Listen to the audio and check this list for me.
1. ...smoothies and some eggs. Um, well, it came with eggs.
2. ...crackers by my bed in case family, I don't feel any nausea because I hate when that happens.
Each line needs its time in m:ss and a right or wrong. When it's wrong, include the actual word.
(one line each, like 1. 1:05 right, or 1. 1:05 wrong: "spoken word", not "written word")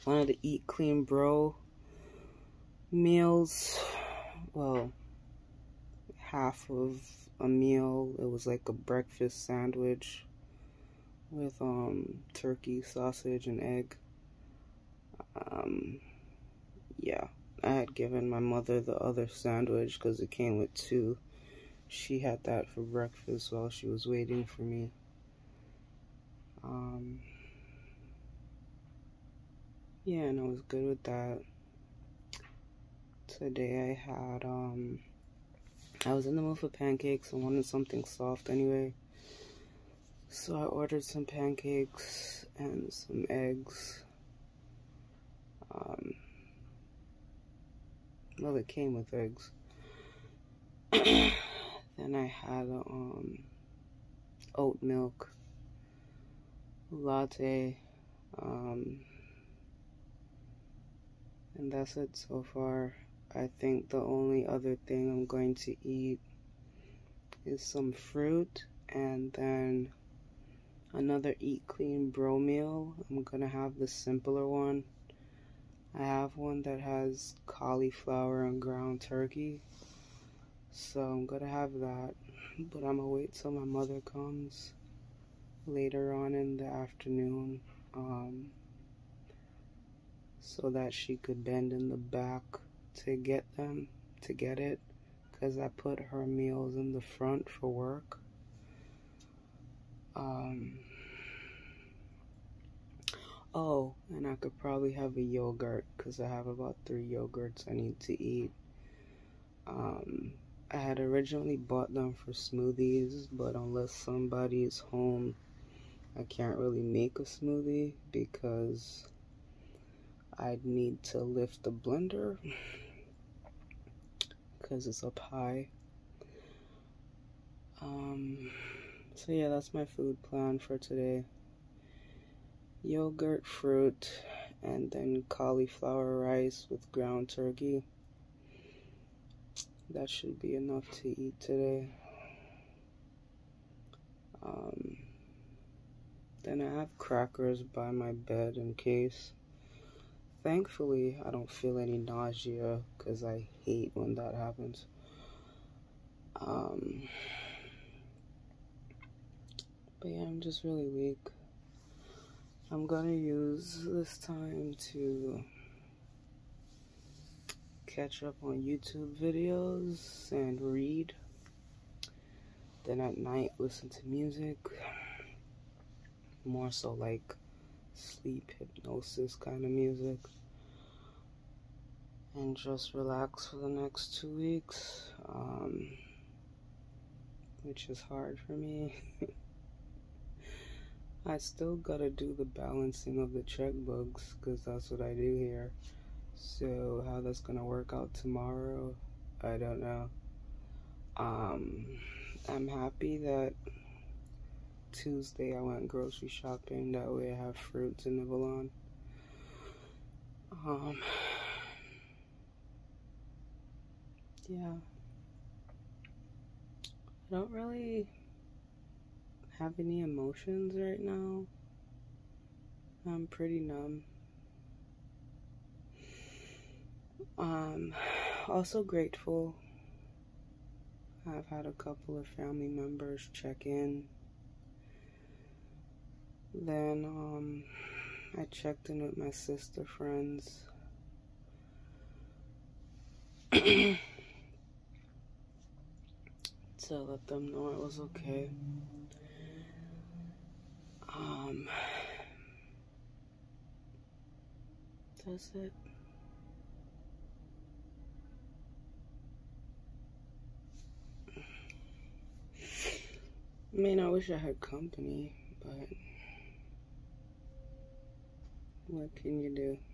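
1. 0:41 wrong: "pancakes", not "smoothies"
2. 2:26 wrong: "thankfully", not "family".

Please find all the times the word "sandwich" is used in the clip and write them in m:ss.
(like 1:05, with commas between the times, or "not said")
0:09, 0:19.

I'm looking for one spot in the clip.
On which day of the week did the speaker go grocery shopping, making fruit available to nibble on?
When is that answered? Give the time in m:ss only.
3:24.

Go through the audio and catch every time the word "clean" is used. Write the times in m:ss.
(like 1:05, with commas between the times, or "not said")
0:00, 1:11.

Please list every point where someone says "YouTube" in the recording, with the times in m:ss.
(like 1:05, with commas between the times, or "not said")
2:48.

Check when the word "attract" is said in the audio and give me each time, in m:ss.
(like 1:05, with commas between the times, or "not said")
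not said.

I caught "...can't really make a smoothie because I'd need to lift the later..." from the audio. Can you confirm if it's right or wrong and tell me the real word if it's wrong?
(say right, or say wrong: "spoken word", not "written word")
wrong: "blender", not "later".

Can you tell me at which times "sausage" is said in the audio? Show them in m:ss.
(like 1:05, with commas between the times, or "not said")
0:12.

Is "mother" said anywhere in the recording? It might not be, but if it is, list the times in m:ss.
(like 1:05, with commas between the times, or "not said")
0:18, 1:23.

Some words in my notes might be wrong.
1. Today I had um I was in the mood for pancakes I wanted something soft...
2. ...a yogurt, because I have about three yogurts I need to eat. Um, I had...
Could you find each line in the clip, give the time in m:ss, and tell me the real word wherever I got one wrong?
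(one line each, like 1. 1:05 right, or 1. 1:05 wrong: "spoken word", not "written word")
1. 0:33 right
2. 1:45 right.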